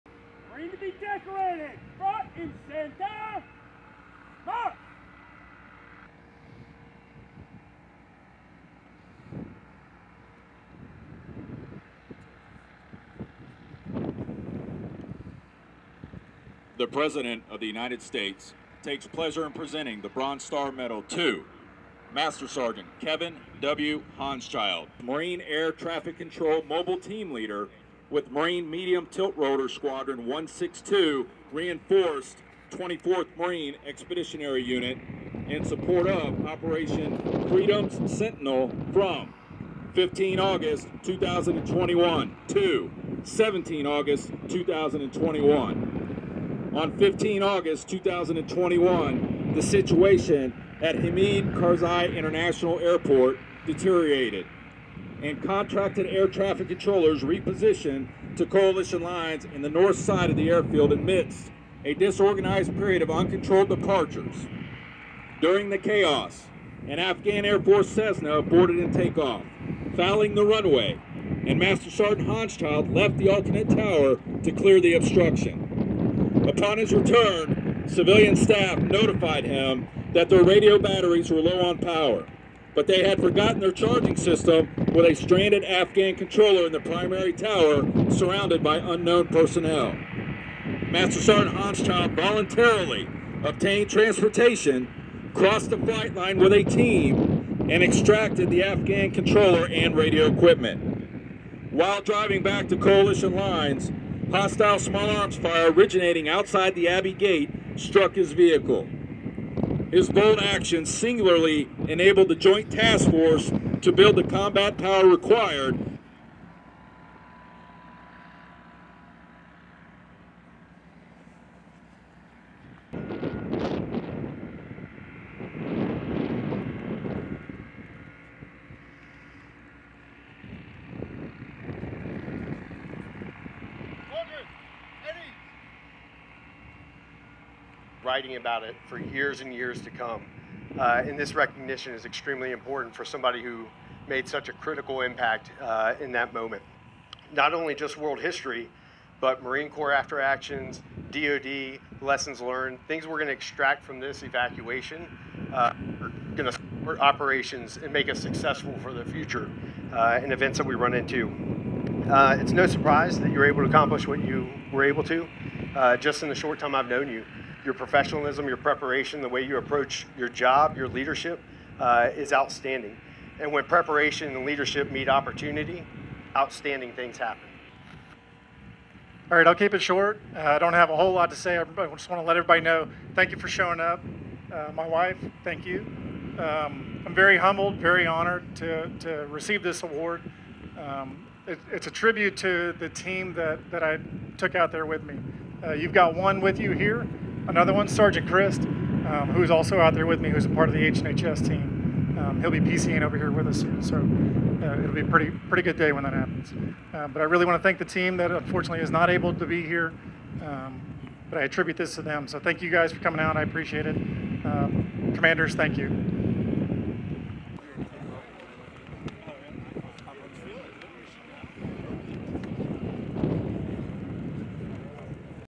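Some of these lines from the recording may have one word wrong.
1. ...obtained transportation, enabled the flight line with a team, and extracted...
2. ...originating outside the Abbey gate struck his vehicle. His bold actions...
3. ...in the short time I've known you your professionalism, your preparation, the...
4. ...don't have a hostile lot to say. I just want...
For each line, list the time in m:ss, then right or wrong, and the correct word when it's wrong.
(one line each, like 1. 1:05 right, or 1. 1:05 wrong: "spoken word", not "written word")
1. 1:33 wrong: "crossed", not "enabled"
2. 1:45 right
3. 2:46 right
4. 3:00 wrong: "whole", not "hostile".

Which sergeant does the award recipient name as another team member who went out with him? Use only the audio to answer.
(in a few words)
Sergeant Christ.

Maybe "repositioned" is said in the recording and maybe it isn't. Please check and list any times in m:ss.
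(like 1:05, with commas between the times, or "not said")
0:57.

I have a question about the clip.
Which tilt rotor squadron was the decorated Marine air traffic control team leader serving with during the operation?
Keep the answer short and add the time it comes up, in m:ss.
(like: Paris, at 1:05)
Marine Medium Tilt Rotor Squadron 162, at 0:28.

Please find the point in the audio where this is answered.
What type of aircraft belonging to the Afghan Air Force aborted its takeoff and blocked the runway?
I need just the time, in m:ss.
1:07.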